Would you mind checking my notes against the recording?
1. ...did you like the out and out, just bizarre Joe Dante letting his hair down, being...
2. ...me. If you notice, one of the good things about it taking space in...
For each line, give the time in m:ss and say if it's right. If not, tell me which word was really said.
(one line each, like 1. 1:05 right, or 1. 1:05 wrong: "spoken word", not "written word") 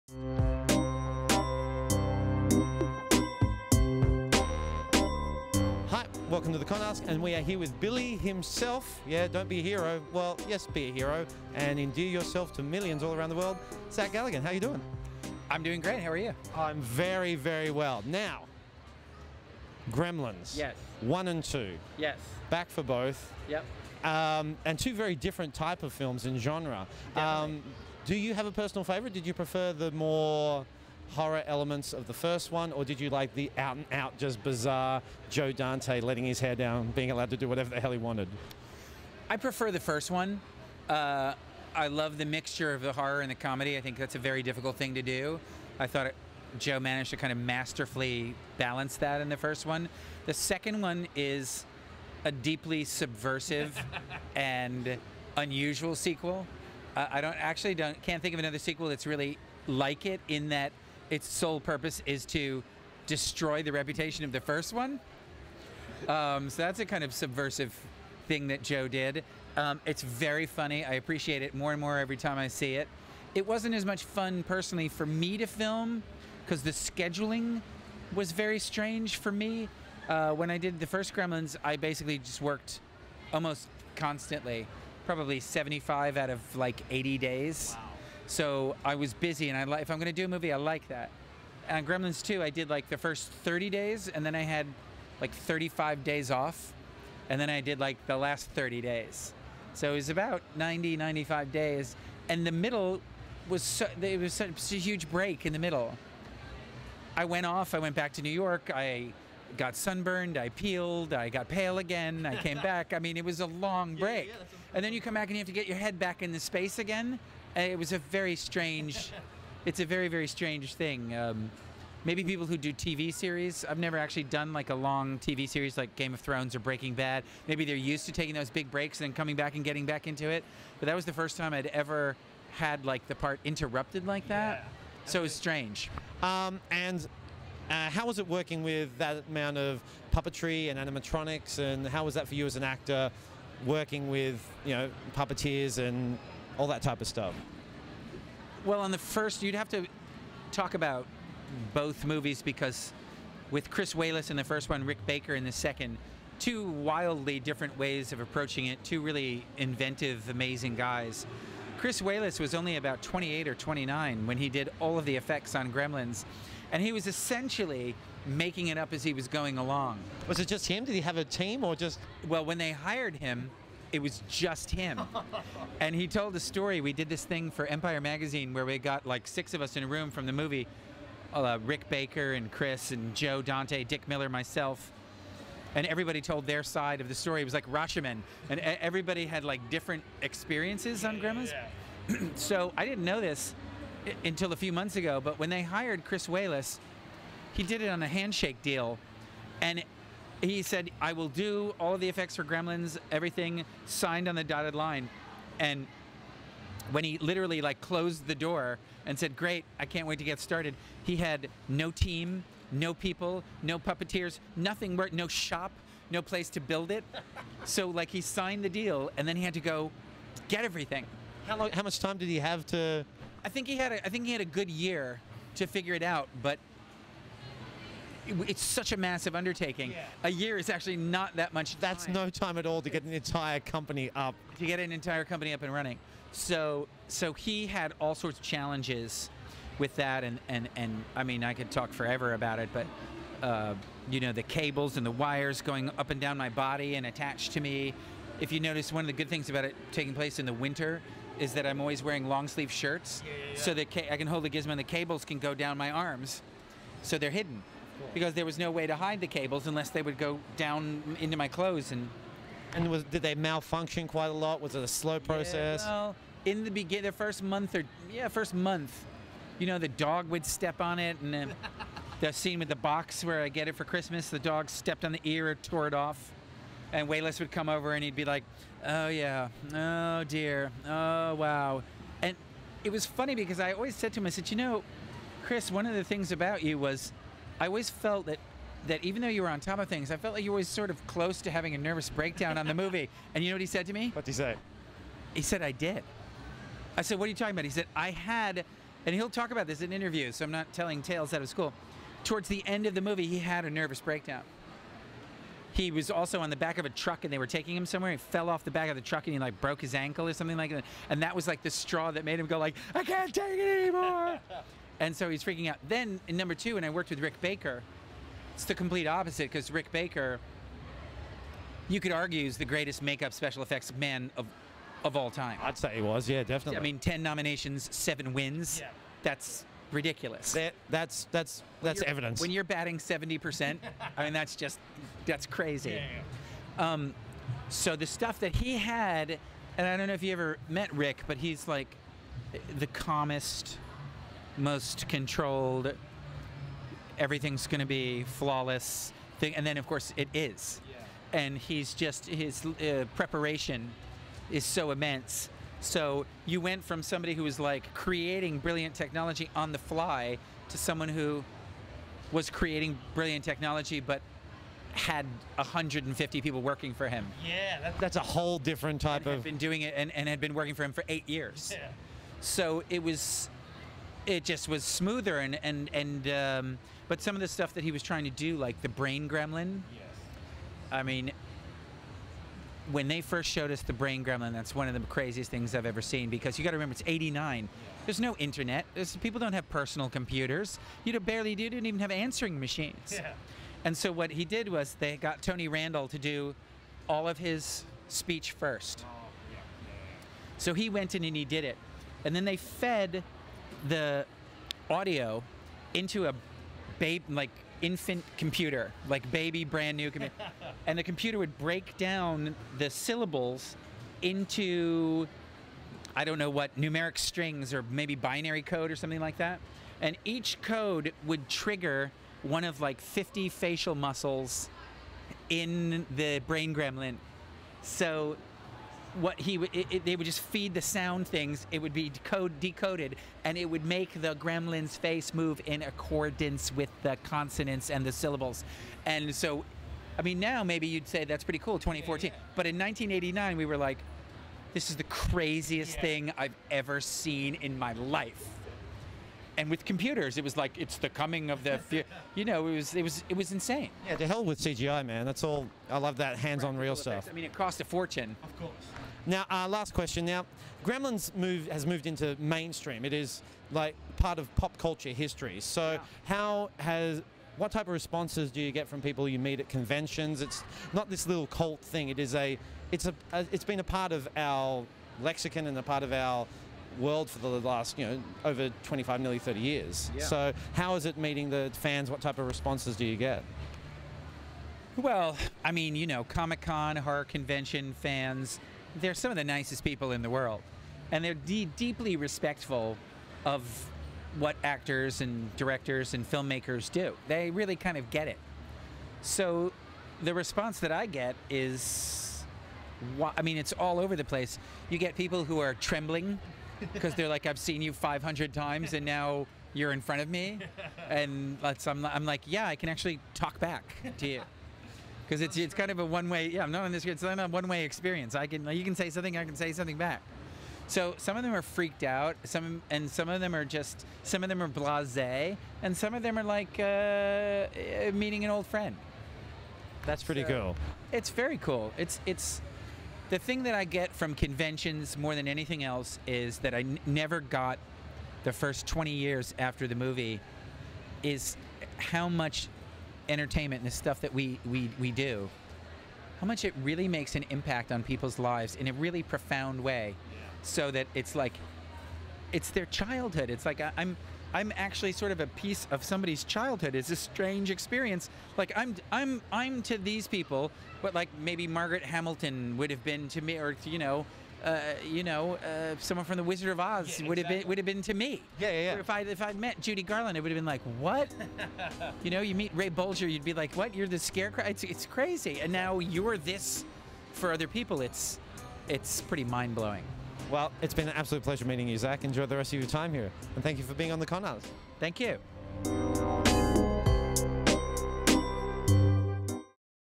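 1. 0:32 right
2. 4:07 wrong: "place", not "space".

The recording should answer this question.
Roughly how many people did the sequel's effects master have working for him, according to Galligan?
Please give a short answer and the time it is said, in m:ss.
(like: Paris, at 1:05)
150, at 6:05.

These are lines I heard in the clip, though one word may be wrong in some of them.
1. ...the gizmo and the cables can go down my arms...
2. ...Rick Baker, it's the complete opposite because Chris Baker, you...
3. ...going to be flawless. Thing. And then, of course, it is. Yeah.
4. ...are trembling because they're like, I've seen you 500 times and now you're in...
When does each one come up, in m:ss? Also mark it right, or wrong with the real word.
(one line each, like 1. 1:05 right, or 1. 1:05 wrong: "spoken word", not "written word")
1. 4:14 right
2. 5:17 wrong: "Rick", not "Chris"
3. 5:47 right
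4. 8:25 right.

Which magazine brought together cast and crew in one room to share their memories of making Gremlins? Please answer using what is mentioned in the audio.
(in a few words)
Empire Magazine.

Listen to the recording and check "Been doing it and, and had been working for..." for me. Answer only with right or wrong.
right.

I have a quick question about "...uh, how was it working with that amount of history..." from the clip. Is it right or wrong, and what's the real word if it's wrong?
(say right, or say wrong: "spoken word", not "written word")
wrong: "puppetry", not "history".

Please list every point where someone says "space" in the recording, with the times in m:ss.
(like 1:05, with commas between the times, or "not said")
1:56.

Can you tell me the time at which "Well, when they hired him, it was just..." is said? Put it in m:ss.
2:52.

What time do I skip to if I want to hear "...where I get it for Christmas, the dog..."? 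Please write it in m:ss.
4:33.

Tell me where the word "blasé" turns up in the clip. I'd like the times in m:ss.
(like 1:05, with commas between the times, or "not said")
8:44.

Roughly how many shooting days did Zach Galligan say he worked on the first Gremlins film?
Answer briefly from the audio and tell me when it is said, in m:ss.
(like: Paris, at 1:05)
75, at 1:25.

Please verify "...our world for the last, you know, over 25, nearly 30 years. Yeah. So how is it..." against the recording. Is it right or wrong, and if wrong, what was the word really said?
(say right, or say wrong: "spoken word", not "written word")
right.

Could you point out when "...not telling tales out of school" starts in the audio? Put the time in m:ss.
5:00.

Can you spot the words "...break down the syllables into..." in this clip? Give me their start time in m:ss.
6:51.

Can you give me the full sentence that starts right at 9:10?
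So that it's like it's their childhood.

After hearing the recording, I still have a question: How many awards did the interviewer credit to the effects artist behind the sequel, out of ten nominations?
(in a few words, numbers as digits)
7.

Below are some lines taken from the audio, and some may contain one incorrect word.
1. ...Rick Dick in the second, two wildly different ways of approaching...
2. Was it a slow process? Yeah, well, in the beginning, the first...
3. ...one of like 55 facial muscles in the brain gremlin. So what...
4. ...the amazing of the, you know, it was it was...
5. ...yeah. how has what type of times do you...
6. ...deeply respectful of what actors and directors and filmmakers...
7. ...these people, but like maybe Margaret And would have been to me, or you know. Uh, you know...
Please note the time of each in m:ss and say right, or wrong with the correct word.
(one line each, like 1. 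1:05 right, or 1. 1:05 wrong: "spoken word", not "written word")
1. 2:34 wrong: "Baker", not "Dick"
2. 4:24 right
3. 7:02 wrong: "50", not "55"
4. 7:30 wrong: "coming", not "amazing"
5. 7:45 wrong: "responses", not "times"
6. 8:11 right
7. 9:19 wrong: "Hamilton", not "And".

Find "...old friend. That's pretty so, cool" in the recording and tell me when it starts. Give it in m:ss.
8:48.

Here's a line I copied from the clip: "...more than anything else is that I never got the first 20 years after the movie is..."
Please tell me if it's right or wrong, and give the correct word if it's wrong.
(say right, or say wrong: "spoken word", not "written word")
right.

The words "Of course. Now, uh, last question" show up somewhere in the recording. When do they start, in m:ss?
7:38.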